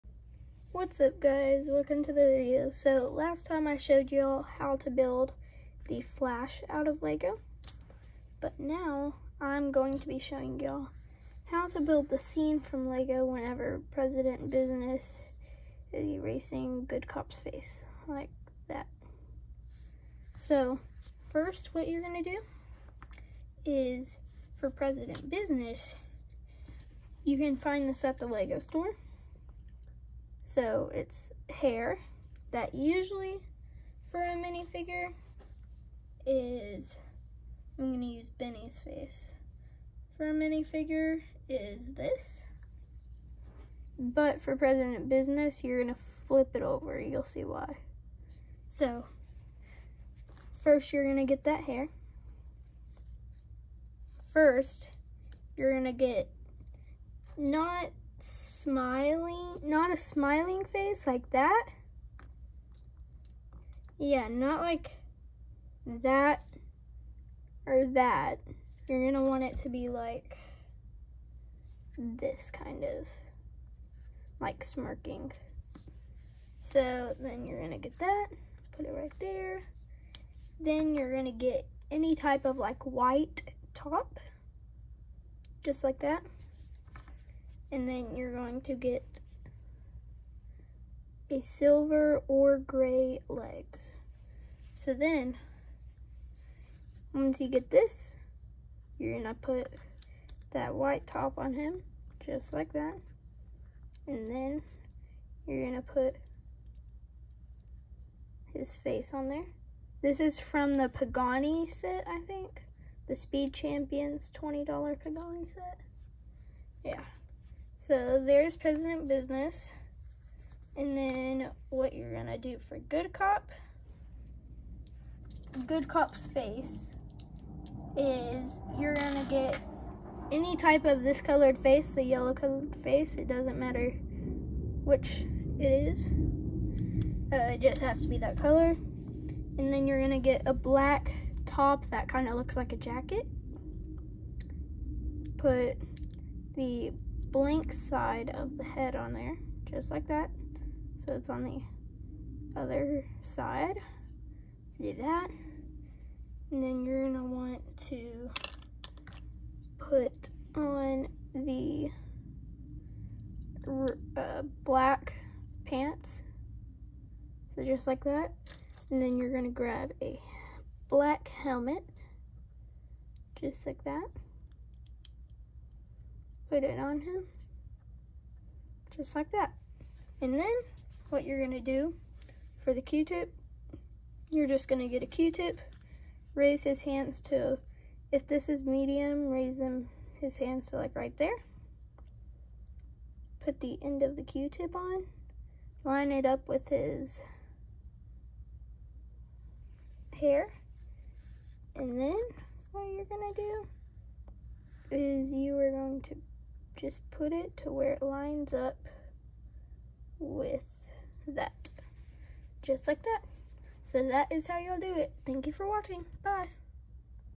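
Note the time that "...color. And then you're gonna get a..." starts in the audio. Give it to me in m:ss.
2:18.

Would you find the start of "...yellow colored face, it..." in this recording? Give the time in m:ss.
2:12.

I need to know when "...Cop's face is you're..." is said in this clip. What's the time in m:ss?
2:05.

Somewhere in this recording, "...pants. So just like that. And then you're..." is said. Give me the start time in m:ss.
2:45.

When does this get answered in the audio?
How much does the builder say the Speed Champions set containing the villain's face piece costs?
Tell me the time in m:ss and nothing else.
1:54.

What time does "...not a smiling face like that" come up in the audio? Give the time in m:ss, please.
0:59.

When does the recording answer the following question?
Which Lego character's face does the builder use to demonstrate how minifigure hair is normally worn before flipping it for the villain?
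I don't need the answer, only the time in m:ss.
0:38.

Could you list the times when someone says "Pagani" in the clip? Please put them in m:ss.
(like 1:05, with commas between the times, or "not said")
1:50, 1:54.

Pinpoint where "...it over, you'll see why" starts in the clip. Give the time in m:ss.
0:46.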